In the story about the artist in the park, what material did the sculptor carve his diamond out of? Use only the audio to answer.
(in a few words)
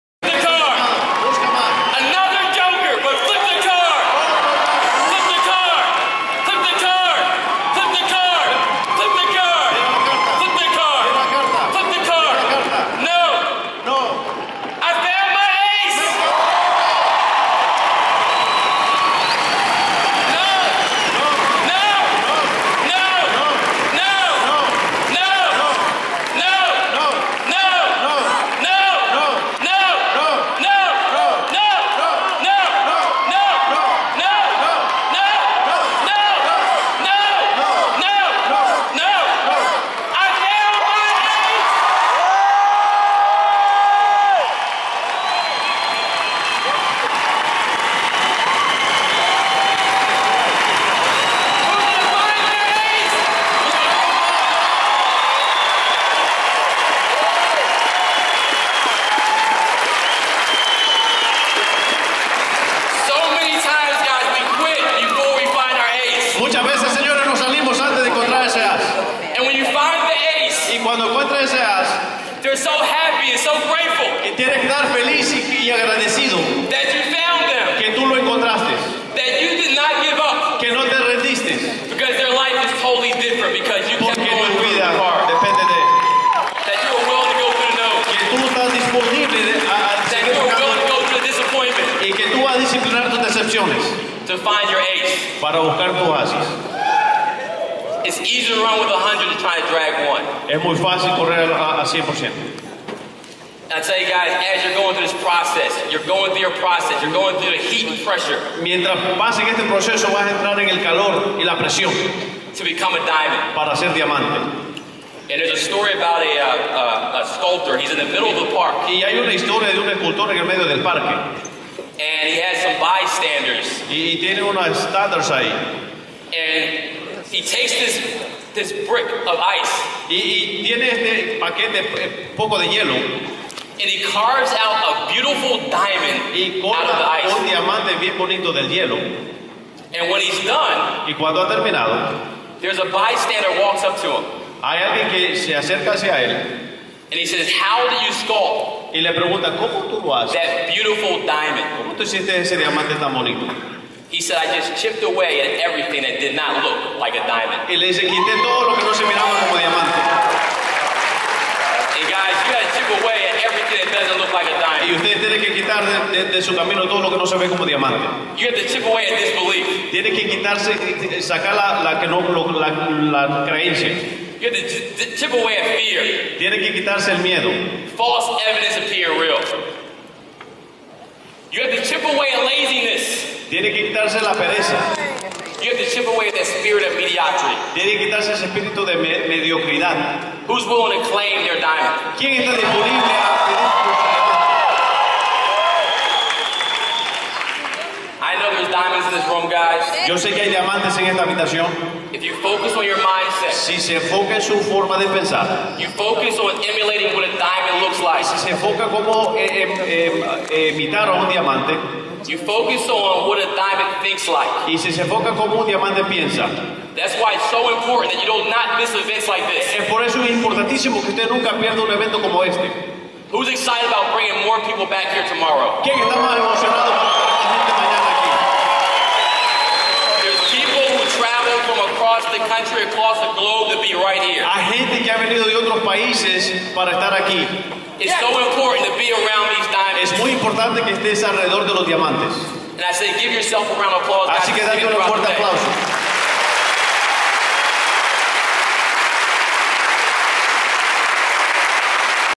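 ice.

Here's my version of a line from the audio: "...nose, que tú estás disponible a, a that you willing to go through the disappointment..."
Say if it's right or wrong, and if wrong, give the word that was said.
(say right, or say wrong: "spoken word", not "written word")
right.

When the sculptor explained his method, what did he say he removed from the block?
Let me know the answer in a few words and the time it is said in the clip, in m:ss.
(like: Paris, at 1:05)
everything that did not look like a diamond, at 2:35.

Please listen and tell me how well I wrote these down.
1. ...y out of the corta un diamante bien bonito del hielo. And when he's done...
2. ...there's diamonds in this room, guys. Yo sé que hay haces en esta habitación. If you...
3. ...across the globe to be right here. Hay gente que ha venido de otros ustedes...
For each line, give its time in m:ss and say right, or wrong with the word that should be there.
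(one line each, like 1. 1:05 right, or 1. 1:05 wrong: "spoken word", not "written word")
1. 2:16 right
2. 3:18 wrong: "diamantes", not "haces"
3. 3:52 wrong: "países", not "ustedes".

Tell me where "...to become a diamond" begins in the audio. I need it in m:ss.
1:52.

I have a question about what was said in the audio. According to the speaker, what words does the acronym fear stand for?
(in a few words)
False evidence appear real.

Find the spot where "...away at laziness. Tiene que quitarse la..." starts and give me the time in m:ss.
3:02.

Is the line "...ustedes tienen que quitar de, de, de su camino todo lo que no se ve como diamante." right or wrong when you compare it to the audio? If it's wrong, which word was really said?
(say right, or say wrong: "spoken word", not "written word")
right.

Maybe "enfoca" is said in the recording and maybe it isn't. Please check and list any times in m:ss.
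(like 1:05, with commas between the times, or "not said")
3:23, 3:28, 3:35.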